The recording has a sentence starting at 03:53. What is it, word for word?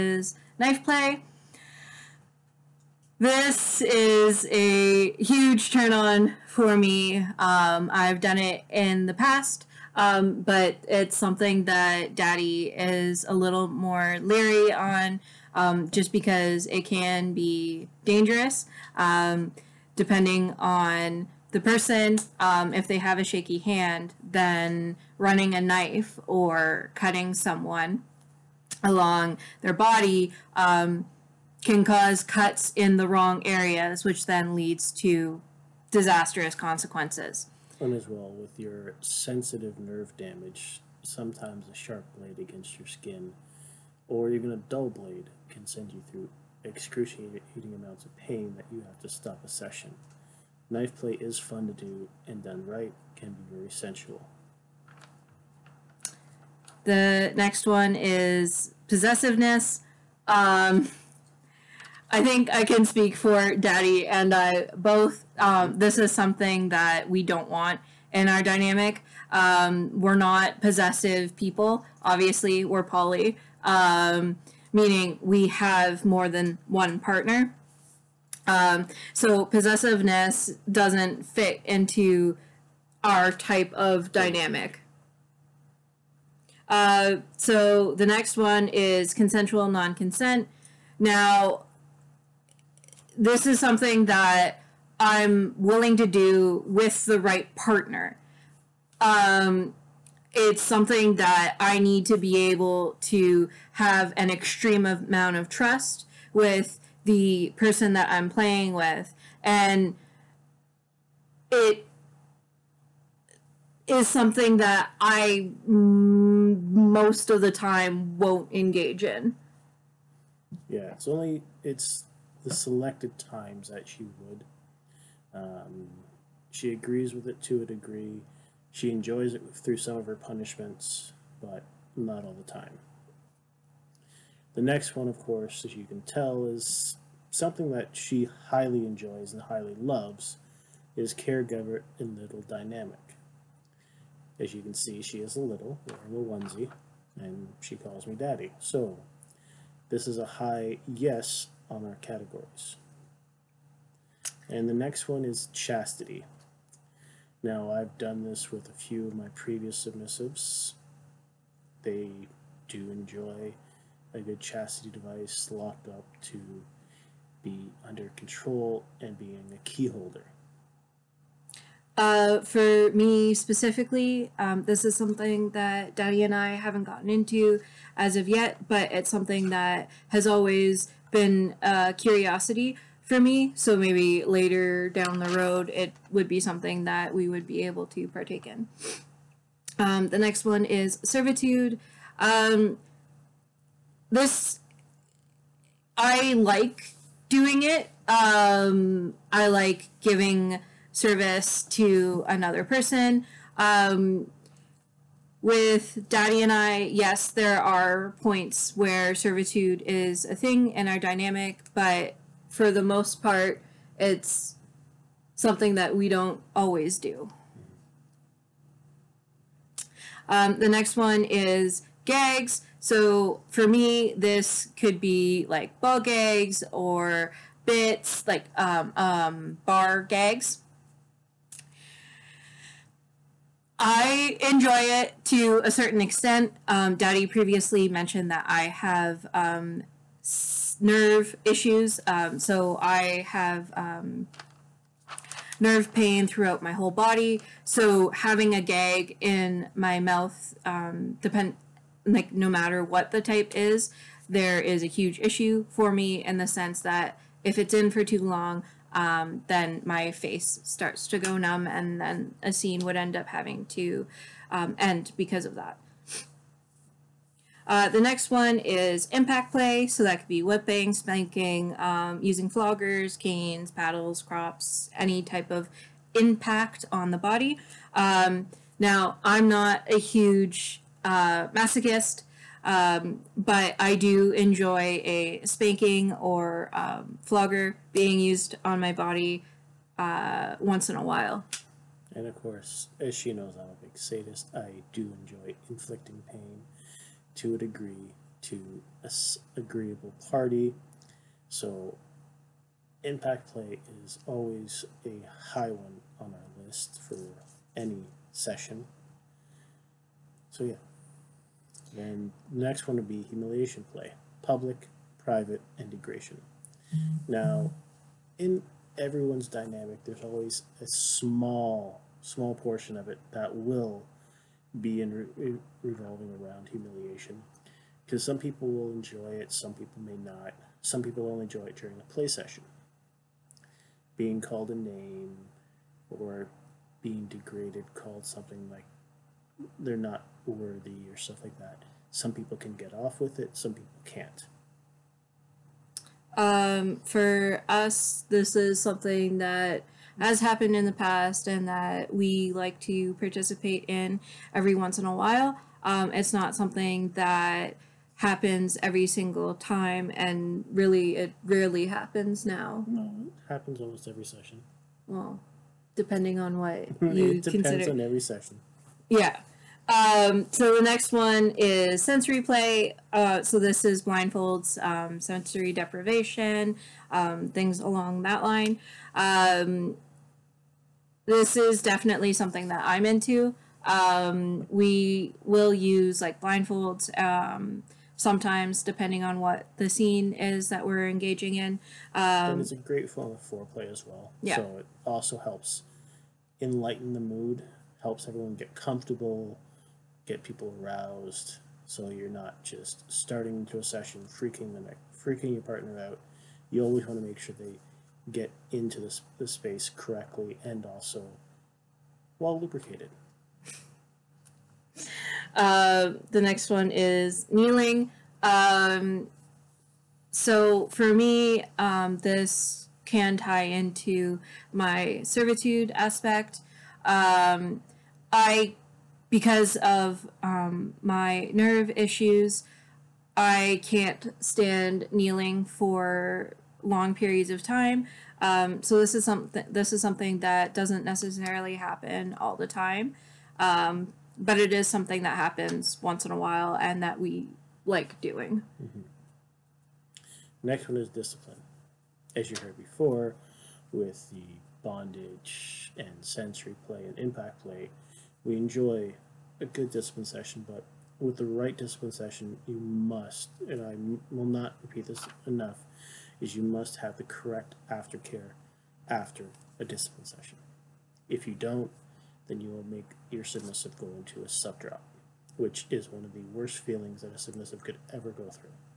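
I enjoy it to a certain extent.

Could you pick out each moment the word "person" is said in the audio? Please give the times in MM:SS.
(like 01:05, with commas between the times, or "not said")
00:21, 01:47, 03:22.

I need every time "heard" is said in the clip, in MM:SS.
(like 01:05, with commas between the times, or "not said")
07:32.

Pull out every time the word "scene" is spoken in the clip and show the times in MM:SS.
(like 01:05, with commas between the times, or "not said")
04:22, 06:29.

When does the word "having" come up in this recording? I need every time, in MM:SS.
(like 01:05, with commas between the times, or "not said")
04:08, 04:23.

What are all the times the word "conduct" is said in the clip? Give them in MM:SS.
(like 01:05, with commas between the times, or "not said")
not said.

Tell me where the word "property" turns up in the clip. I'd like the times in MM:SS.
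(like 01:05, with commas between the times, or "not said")
not said.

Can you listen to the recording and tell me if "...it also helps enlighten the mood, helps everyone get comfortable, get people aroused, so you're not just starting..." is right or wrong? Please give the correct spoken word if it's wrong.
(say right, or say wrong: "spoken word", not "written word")
right.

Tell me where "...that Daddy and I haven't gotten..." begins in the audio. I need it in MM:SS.
02:55.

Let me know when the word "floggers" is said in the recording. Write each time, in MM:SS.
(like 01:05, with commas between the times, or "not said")
04:32, 04:47.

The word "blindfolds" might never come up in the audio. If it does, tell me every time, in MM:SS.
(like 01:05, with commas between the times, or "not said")
06:14, 06:26.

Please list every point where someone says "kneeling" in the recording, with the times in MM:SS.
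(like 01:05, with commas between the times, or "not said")
06:57, 07:15.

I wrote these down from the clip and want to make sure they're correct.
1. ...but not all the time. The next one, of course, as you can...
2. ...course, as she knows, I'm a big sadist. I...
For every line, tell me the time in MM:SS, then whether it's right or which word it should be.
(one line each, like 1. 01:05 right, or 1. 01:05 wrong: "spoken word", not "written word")
1. 02:11 right
2. 04:52 right.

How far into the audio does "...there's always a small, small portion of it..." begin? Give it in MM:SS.
05:20.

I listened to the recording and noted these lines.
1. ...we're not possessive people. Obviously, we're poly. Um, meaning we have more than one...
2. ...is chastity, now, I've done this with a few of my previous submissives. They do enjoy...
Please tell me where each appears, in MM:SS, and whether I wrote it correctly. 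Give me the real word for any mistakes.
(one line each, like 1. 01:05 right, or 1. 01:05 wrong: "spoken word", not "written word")
1. 01:10 right
2. 02:35 right.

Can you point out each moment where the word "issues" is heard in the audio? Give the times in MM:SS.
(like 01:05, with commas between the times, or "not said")
04:01, 04:15, 07:11.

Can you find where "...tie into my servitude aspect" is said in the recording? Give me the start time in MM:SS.
07:03.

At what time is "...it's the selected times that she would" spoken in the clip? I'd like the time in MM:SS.
02:01.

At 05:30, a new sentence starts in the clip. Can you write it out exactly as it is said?
Some people only enjoy it during a play session.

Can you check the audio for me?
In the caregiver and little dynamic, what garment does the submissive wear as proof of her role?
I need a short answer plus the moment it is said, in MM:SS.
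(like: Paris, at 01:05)
onesie, at 02:26.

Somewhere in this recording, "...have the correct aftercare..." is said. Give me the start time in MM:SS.
07:46.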